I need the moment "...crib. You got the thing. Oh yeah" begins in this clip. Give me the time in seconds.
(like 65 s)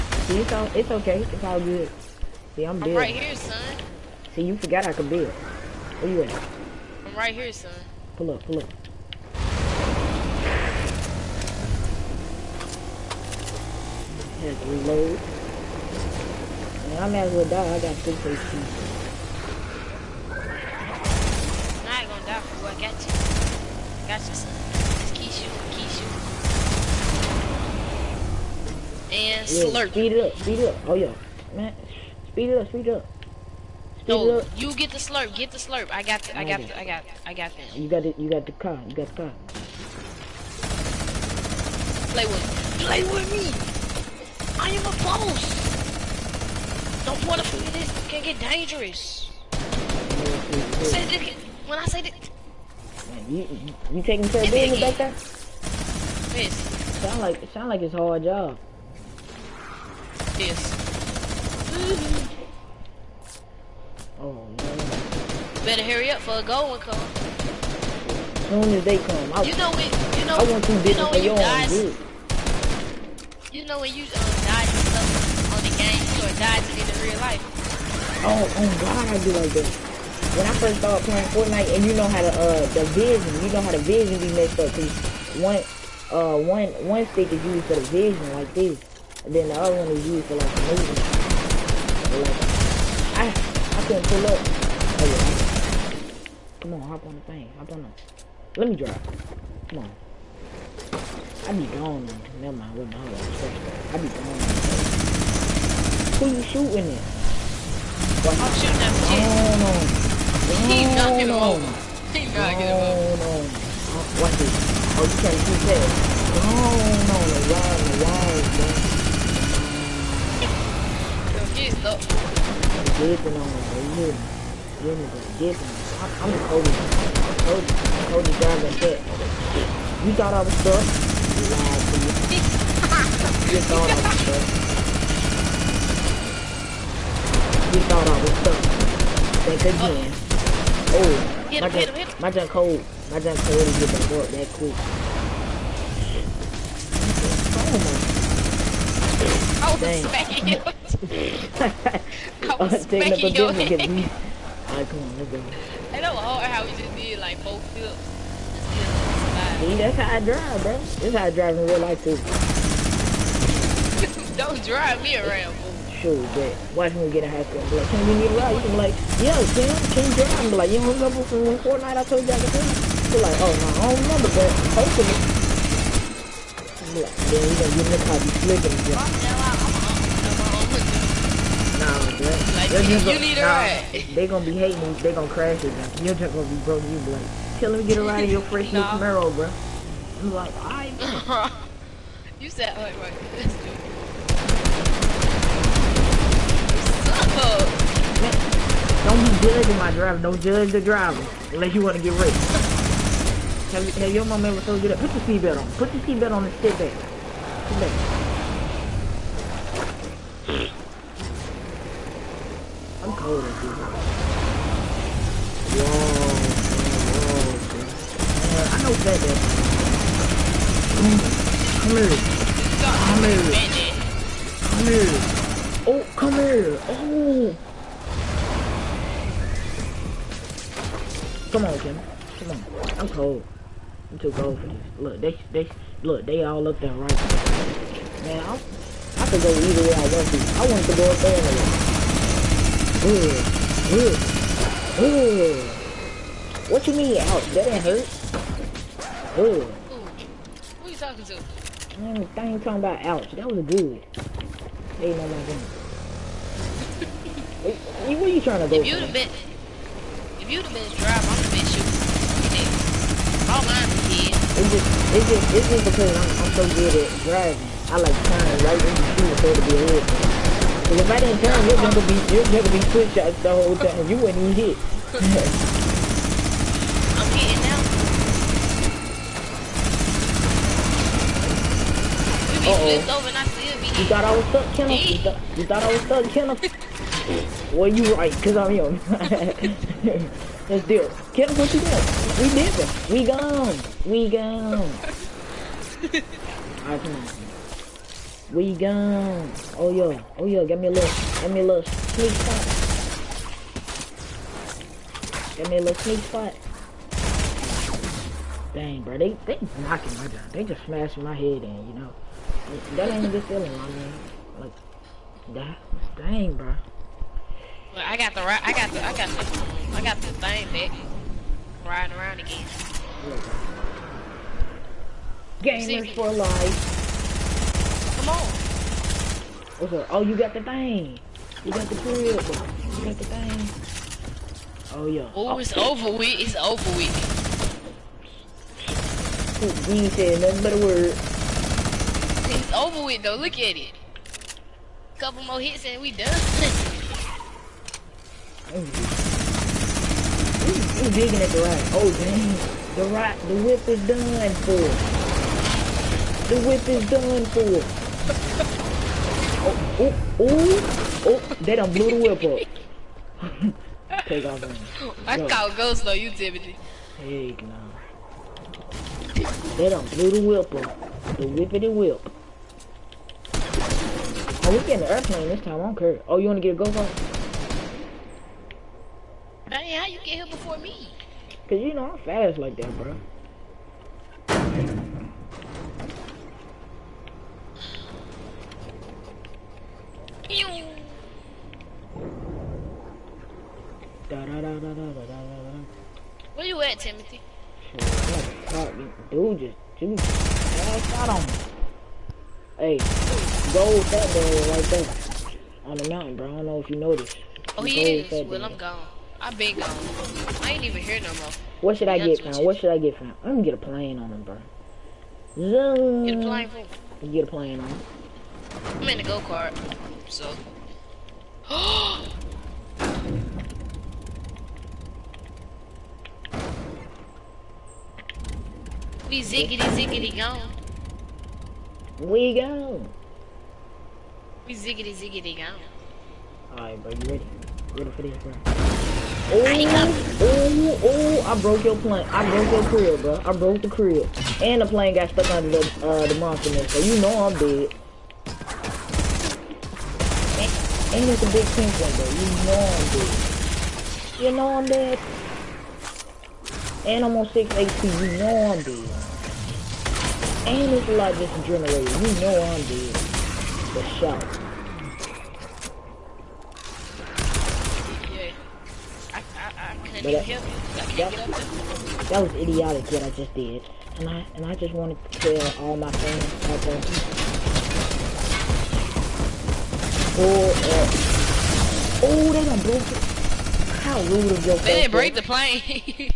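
331 s.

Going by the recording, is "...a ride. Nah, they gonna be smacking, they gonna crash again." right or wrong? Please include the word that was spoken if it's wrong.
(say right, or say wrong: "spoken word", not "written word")
wrong: "hating", not "smacking".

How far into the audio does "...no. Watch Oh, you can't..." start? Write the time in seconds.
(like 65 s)
113 s.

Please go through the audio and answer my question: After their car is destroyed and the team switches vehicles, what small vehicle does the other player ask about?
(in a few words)
go-go.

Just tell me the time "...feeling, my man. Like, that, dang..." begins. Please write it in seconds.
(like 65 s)
313 s.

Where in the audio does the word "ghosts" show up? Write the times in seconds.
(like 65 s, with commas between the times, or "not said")
365 s.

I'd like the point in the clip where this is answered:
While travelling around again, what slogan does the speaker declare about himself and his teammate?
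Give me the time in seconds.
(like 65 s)
325 s.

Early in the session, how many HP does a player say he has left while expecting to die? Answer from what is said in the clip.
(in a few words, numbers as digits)
2.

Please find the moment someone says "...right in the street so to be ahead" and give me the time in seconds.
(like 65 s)
268 s.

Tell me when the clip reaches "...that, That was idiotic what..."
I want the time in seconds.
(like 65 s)
470 s.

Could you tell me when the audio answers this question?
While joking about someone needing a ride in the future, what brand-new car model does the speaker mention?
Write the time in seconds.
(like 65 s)
188 s.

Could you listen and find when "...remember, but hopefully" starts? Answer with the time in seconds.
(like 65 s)
174 s.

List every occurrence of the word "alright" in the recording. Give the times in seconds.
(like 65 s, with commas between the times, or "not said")
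153 s, 190 s, 296 s, 436 s.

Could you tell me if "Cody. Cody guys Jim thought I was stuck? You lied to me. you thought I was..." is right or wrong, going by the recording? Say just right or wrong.
wrong.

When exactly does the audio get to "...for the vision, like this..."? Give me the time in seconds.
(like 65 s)
87 s.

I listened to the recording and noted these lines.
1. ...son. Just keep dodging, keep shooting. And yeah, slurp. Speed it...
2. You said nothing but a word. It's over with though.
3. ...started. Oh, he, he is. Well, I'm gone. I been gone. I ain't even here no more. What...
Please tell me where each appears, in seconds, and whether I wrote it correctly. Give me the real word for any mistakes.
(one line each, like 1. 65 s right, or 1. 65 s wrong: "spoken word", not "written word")
1. 24 s wrong: "shooting", not "dodging"
2. 339 s right
3. 406 s wrong: "noticed", not "started".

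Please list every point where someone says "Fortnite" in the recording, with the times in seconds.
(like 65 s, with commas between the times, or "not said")
81 s, 171 s.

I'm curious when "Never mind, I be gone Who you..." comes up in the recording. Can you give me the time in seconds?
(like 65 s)
102 s.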